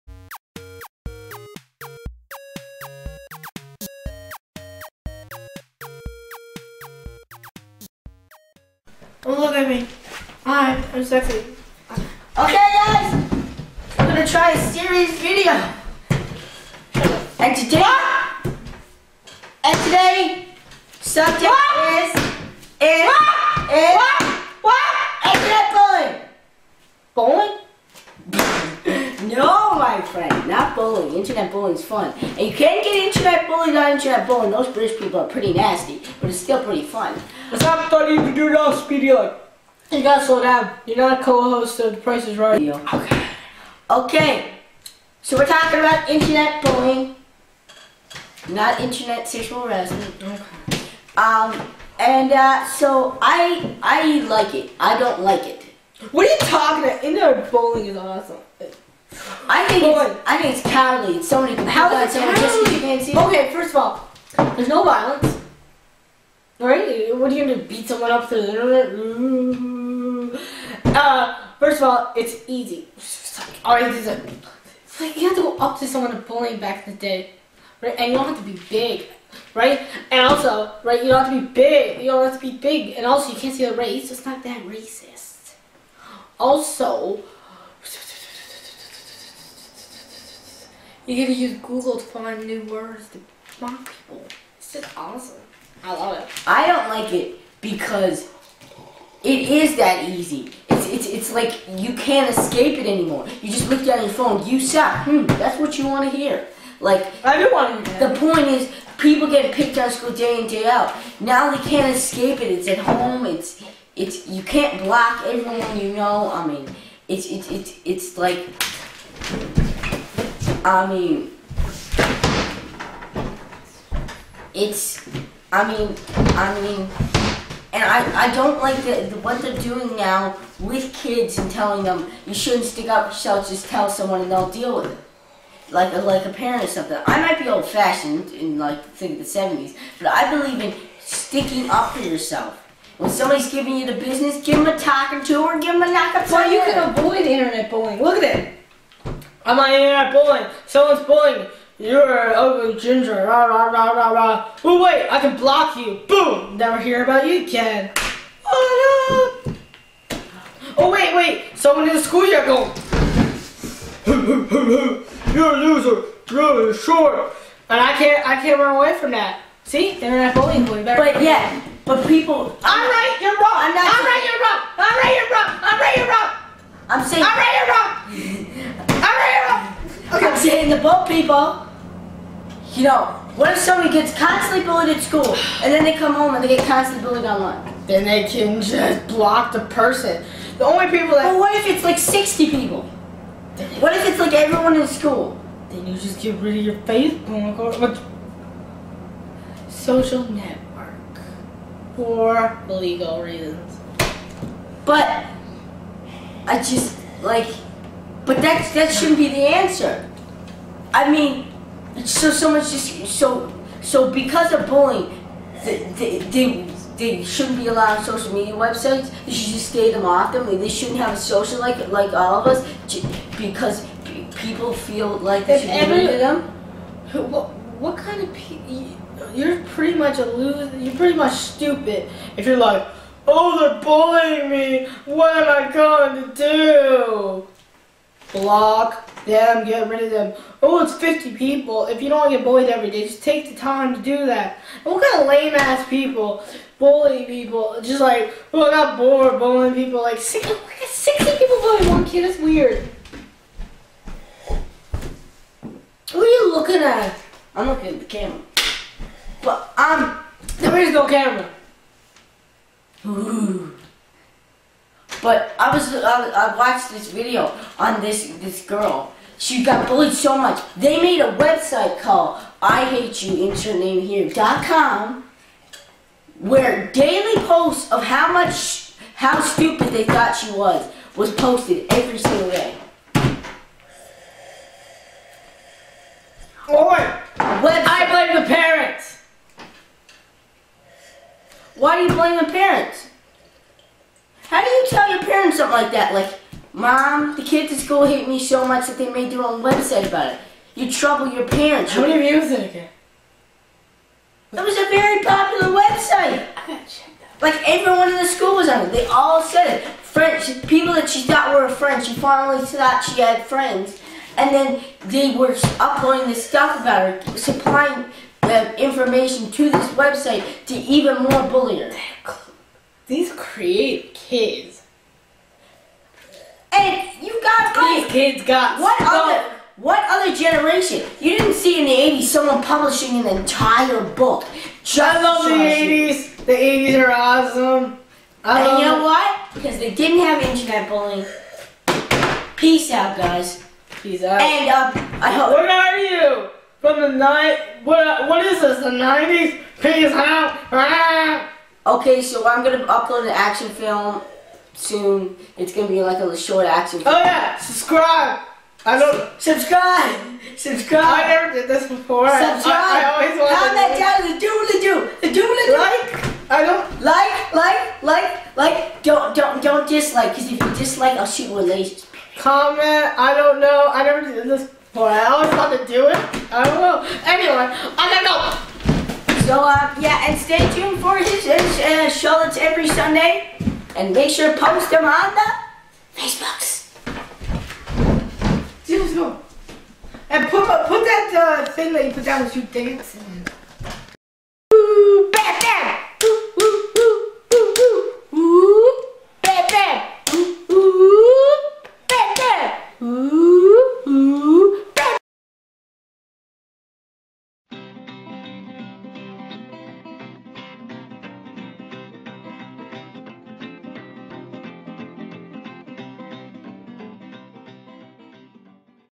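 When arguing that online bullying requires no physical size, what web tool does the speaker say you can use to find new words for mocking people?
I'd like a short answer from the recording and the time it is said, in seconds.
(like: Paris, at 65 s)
Google, at 91 s.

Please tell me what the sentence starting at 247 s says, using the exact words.
Just like, oh, I got bored bullying people.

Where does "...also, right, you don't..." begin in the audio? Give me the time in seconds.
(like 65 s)
80 s.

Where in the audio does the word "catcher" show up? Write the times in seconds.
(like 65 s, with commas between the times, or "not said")
not said.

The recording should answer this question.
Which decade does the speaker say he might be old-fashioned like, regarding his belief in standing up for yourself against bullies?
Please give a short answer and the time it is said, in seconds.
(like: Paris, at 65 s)
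the 70s, at 139 s.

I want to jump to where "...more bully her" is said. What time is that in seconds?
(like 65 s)
321 s.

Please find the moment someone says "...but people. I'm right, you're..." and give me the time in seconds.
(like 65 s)
171 s.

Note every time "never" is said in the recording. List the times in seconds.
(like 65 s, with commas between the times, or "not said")
156 s, 361 s, 374 s.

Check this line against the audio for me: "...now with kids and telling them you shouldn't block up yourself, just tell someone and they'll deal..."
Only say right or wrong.
wrong.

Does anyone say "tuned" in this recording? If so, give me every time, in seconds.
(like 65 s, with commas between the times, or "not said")
380 s.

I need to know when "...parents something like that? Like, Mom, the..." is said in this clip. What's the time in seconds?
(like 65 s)
295 s.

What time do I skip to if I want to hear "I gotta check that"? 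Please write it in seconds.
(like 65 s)
306 s.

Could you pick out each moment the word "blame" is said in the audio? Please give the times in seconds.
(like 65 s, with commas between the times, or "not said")
288 s, 292 s.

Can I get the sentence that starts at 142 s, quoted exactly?
When somebody's giving you the business, give them a or two, or give them a knock Well, you can avoid internet bullying.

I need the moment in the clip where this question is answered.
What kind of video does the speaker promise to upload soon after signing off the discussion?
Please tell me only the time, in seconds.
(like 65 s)
356 s.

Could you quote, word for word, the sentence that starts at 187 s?
Then they can just block the person.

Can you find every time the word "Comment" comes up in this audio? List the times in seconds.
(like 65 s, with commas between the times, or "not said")
363 s, 372 s.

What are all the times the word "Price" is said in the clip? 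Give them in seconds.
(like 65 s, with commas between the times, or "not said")
42 s.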